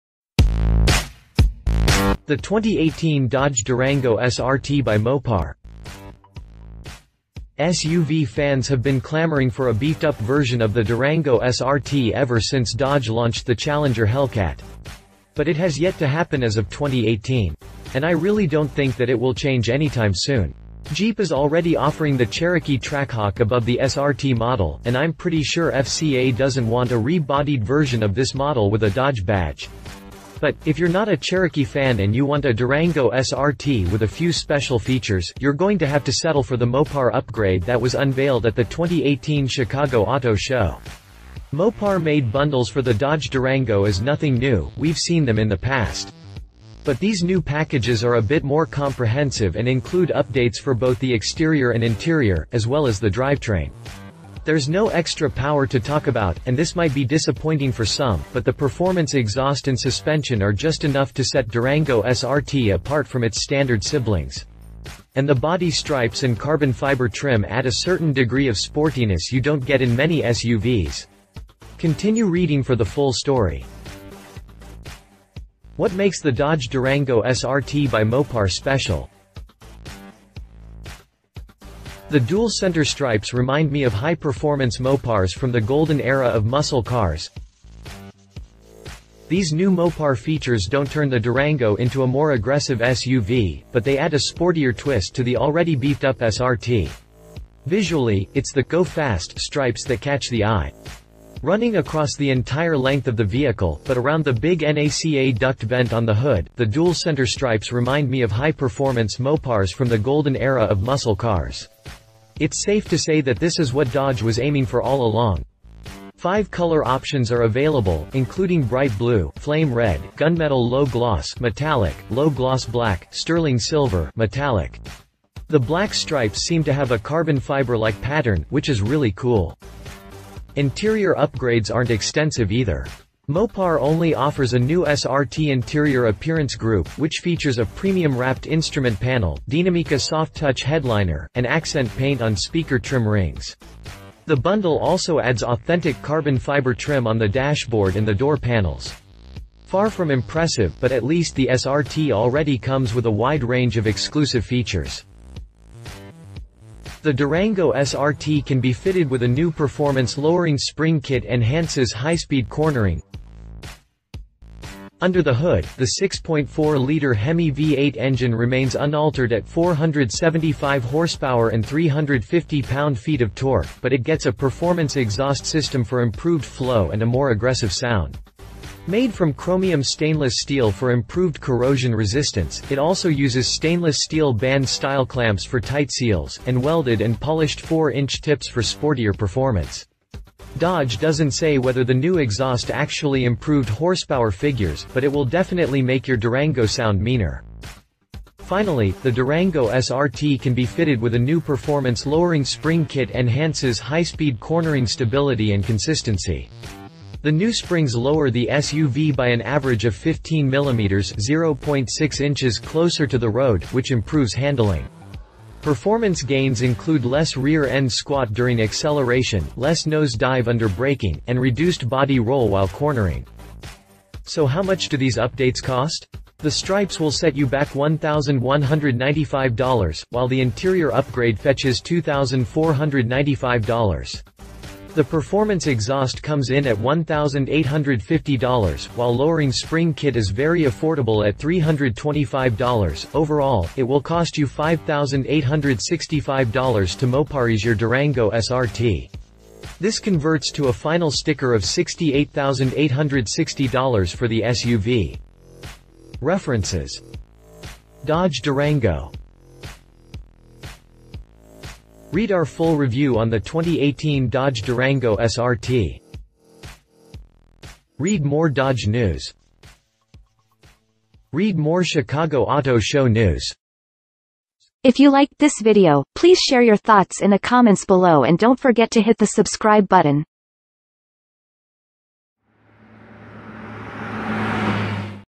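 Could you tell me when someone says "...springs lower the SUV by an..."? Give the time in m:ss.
3:27.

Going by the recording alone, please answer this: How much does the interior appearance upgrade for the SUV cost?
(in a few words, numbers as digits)
$2,495.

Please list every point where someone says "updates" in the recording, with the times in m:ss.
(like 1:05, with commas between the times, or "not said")
0:50, 3:45.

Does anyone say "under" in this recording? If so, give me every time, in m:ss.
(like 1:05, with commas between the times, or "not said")
2:45, 3:40.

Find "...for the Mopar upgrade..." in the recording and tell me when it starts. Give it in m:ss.
0:36.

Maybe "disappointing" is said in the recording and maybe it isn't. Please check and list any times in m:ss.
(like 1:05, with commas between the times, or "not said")
0:57.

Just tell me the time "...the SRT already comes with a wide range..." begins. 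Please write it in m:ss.
2:31.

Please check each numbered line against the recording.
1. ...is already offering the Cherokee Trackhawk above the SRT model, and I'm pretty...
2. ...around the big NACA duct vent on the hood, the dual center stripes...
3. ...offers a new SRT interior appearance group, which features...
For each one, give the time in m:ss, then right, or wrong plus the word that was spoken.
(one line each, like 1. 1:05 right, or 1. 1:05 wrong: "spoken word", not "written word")
1. 0:21 right
2. 1:43 right
3. 2:14 right.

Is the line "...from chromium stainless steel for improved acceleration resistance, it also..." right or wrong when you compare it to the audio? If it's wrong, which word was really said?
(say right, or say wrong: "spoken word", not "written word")
wrong: "corrosion", not "acceleration".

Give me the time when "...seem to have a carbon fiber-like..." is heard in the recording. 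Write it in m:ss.
2:06.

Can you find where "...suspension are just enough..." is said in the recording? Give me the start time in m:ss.
0:59.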